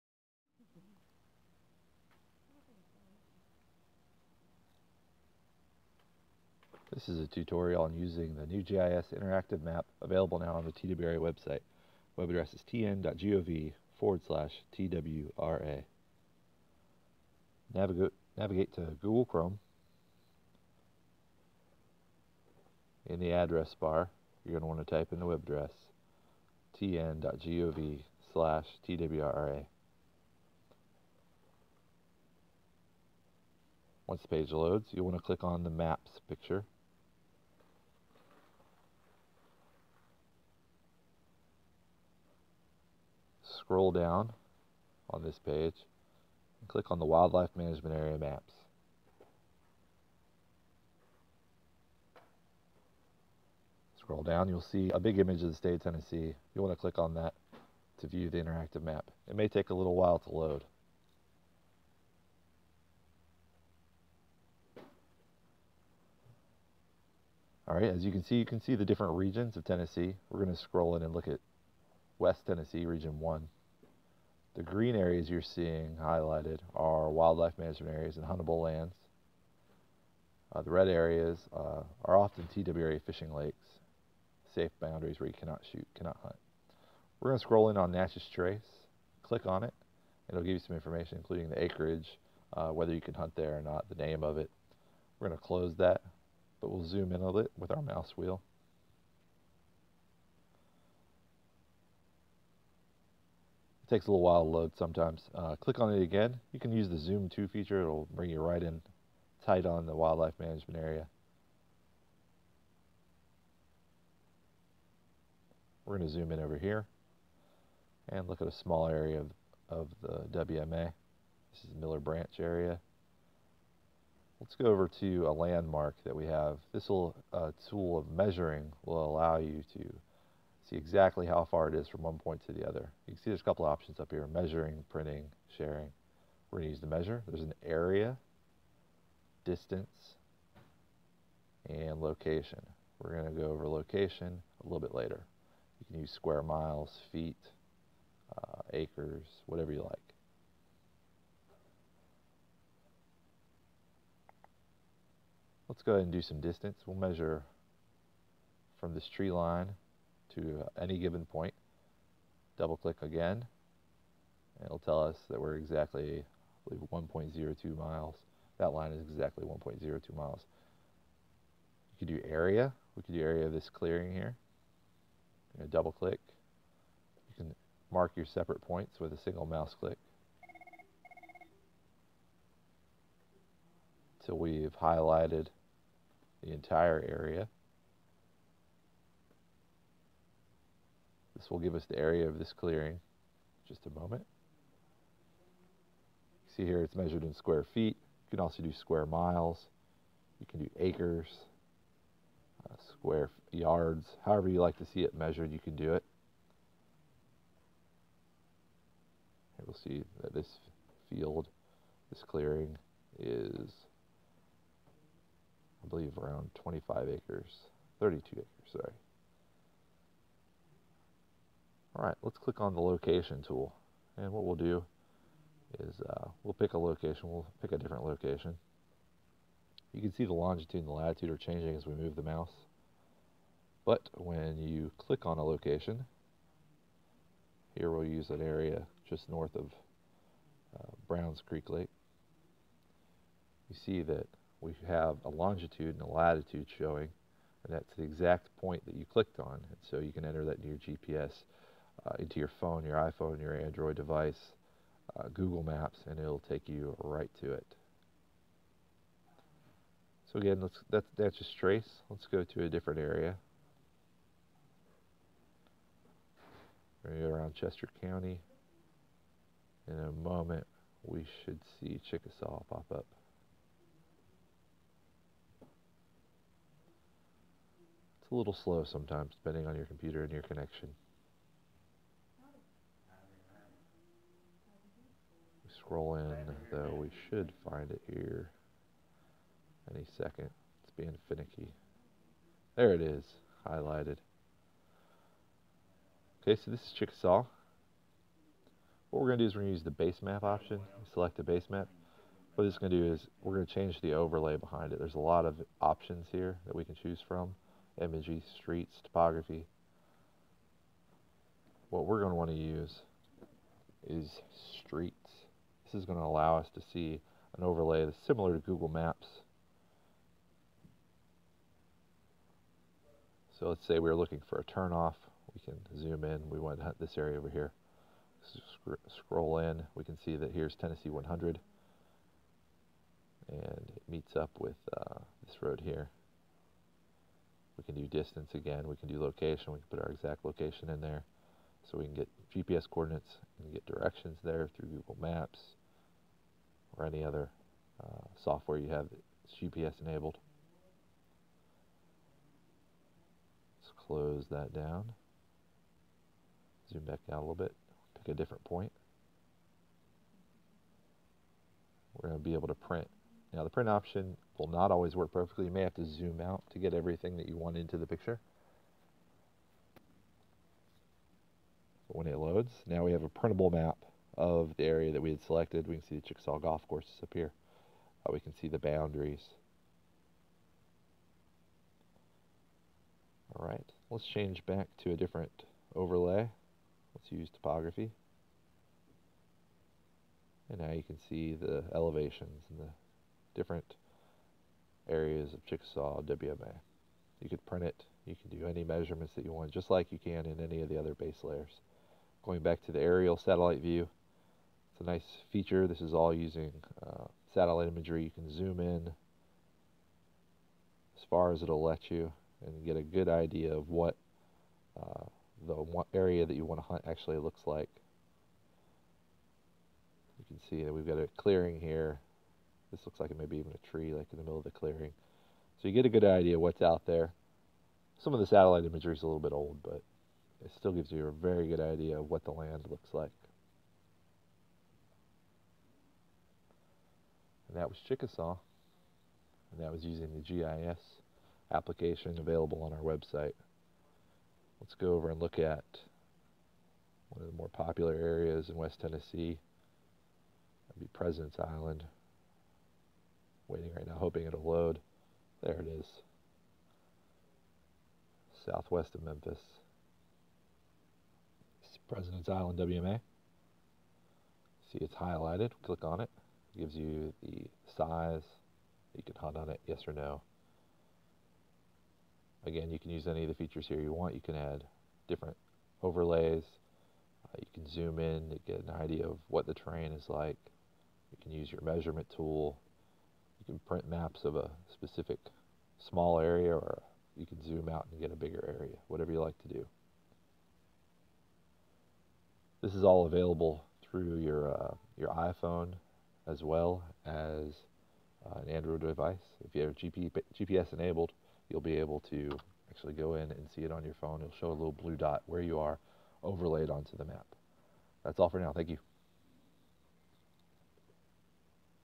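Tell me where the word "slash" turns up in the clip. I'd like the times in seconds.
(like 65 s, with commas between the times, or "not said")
14 s, 28 s.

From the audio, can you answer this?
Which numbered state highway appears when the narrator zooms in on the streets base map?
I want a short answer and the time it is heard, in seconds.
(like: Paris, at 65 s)
Tennessee 100, at 330 s.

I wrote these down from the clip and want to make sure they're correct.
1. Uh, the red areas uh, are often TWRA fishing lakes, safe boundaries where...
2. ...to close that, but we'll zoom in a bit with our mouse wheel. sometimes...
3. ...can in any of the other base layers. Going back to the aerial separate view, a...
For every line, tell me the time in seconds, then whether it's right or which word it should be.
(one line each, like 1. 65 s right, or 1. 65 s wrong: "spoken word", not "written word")
1. 80 s right
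2. 95 s wrong: "takes", not "sometimes"
3. 400 s wrong: "satellite", not "separate".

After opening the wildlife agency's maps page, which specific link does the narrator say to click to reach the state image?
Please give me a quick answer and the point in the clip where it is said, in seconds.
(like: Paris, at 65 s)
Wildlife Management Area Maps, at 47 s.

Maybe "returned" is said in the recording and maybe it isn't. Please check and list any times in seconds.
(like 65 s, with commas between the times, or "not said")
not said.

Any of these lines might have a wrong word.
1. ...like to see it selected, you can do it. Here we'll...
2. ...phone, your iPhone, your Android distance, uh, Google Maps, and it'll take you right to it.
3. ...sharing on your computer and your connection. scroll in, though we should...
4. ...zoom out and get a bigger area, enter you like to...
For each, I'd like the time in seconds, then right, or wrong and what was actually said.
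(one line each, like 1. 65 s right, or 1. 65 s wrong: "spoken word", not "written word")
1. 204 s wrong: "measured", not "selected"
2. 252 s wrong: "device", not "distance"
3. 279 s wrong: "depending", not "sharing"
4. 487 s wrong: "whatever", not "enter".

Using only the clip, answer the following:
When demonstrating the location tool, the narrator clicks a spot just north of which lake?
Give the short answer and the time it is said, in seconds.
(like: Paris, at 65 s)
Browns Creek Lake, at 241 s.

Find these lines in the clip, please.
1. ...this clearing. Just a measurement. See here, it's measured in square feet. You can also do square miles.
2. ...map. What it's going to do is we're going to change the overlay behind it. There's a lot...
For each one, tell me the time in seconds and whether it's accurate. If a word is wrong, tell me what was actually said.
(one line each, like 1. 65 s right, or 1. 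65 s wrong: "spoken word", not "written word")
1. 192 s wrong: "moment", not "measurement"
2. 301 s right.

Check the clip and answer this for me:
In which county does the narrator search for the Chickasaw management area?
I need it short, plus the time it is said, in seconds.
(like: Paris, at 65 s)
Chester County, at 267 s.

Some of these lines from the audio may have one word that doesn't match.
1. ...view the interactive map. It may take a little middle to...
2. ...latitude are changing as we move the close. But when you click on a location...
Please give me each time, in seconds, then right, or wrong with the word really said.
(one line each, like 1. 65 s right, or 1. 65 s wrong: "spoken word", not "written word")
1. 58 s wrong: "while", not "middle"
2. 230 s wrong: "mouse", not "close".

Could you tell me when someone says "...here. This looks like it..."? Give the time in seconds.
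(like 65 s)
421 s.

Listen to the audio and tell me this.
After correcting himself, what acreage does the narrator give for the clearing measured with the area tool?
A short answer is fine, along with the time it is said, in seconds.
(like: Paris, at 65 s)
32 acres, at 217 s.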